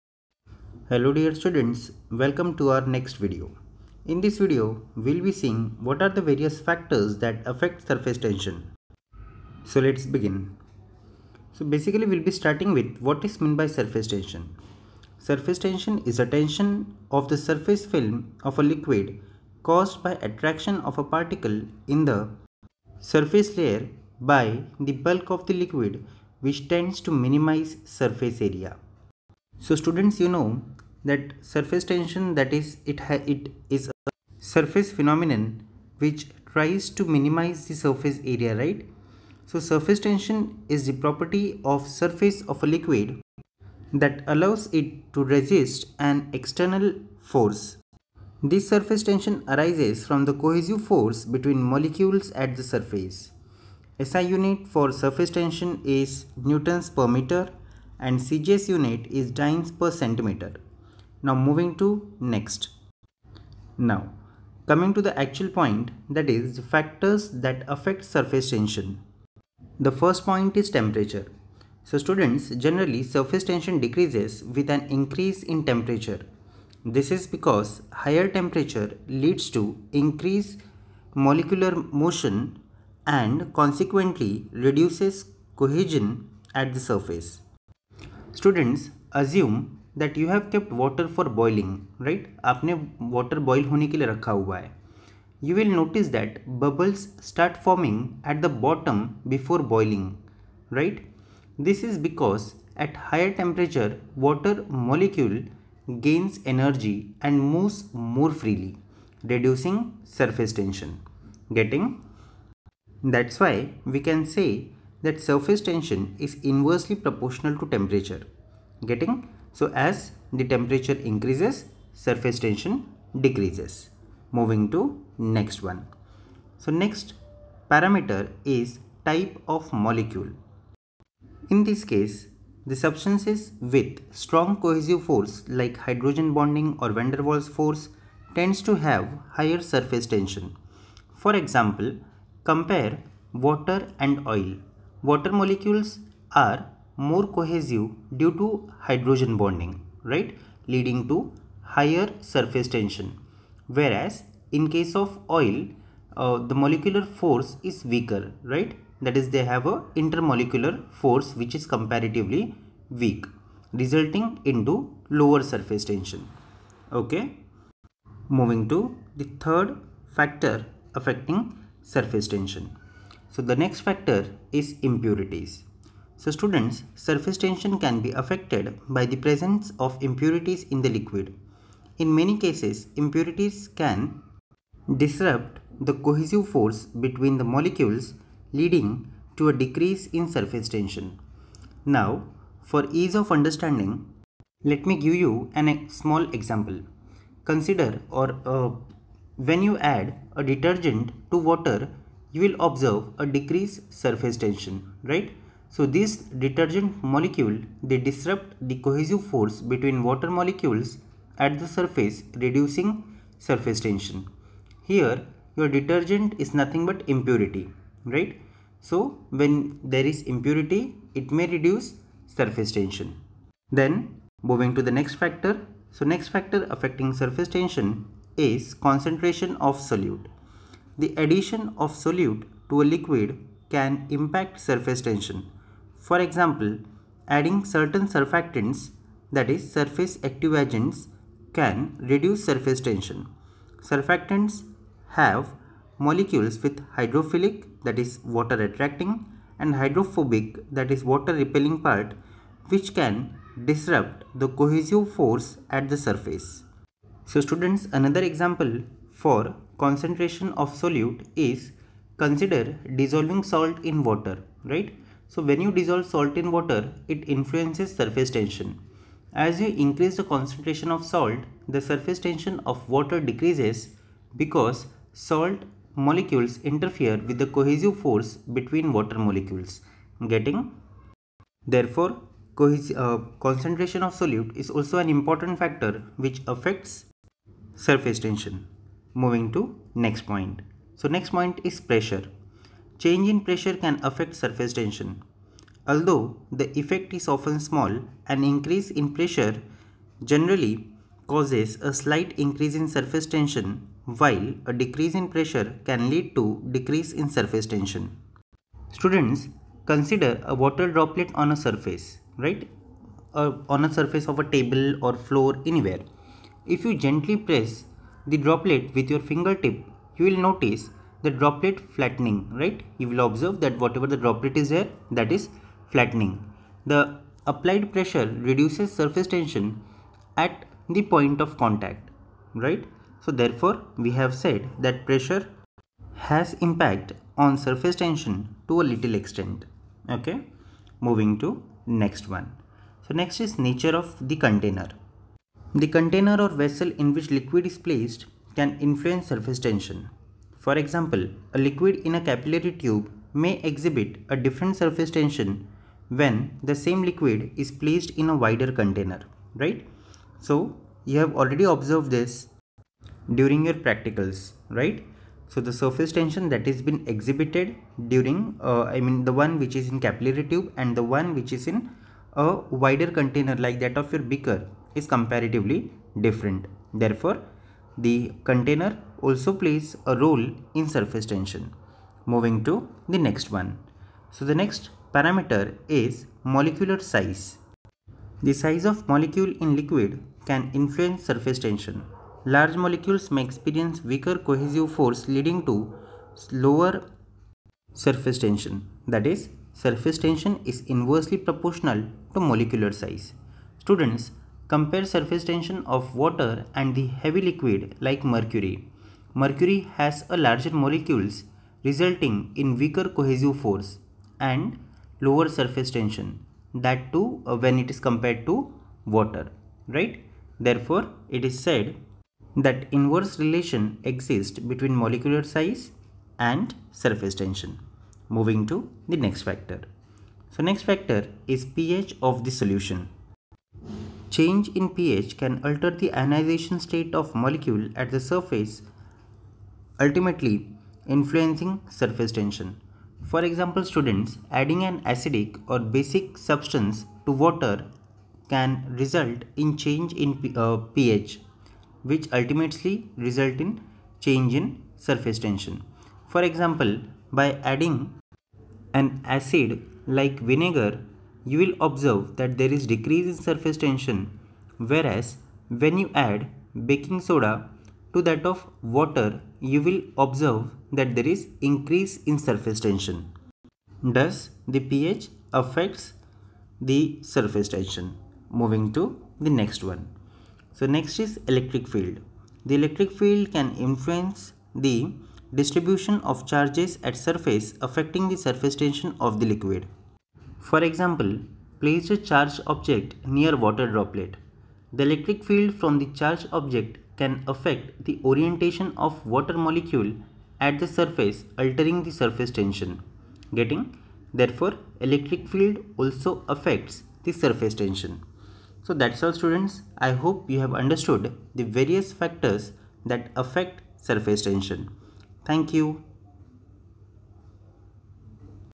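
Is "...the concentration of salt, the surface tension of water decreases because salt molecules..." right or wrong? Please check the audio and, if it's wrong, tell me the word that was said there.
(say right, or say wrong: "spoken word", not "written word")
right.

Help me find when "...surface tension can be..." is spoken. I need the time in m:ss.
2:56.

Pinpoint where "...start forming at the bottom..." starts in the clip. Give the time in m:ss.
1:37.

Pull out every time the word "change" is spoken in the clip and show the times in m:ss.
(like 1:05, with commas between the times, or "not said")
4:53, 7:14, 7:29, 7:34.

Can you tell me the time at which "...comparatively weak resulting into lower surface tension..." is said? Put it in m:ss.
2:41.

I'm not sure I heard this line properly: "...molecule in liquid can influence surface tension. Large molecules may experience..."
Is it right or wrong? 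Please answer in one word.
right.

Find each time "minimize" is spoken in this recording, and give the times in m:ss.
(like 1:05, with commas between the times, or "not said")
0:27, 0:37.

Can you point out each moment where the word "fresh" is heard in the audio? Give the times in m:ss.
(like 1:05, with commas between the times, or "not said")
not said.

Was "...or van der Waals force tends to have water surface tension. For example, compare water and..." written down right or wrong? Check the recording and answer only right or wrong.
wrong.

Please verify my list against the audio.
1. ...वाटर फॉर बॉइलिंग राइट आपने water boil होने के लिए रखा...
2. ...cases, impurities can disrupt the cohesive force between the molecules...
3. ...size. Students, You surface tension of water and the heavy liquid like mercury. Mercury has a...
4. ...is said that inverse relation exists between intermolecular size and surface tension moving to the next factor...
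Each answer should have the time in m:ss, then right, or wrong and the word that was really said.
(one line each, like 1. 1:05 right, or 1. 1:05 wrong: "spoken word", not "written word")
1. 1:30 right
2. 3:02 right
3. 6:42 wrong: "Compare", not "You"
4. 7:01 wrong: "molecular", not "intermolecular".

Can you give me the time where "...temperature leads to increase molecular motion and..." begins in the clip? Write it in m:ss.
1:18.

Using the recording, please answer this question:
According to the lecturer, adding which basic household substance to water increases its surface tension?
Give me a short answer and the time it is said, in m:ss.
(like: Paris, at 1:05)
baking soda, at 7:46.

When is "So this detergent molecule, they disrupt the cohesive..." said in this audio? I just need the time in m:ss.
3:25.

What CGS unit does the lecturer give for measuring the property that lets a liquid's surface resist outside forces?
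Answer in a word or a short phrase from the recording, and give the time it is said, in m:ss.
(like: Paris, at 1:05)
dynes per centimeter, at 0:59.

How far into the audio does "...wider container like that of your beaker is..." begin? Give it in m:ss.
6:12.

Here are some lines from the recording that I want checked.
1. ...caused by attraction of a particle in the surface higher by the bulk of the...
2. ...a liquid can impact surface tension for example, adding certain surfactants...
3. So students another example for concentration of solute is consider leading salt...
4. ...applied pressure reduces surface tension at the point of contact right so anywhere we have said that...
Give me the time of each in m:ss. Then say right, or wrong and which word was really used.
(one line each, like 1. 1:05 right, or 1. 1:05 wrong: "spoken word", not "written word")
1. 0:19 wrong: "layer", not "higher"
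2. 3:52 right
3. 4:17 wrong: "dissolving", not "leading"
4. 5:27 wrong: "therefore", not "anywhere".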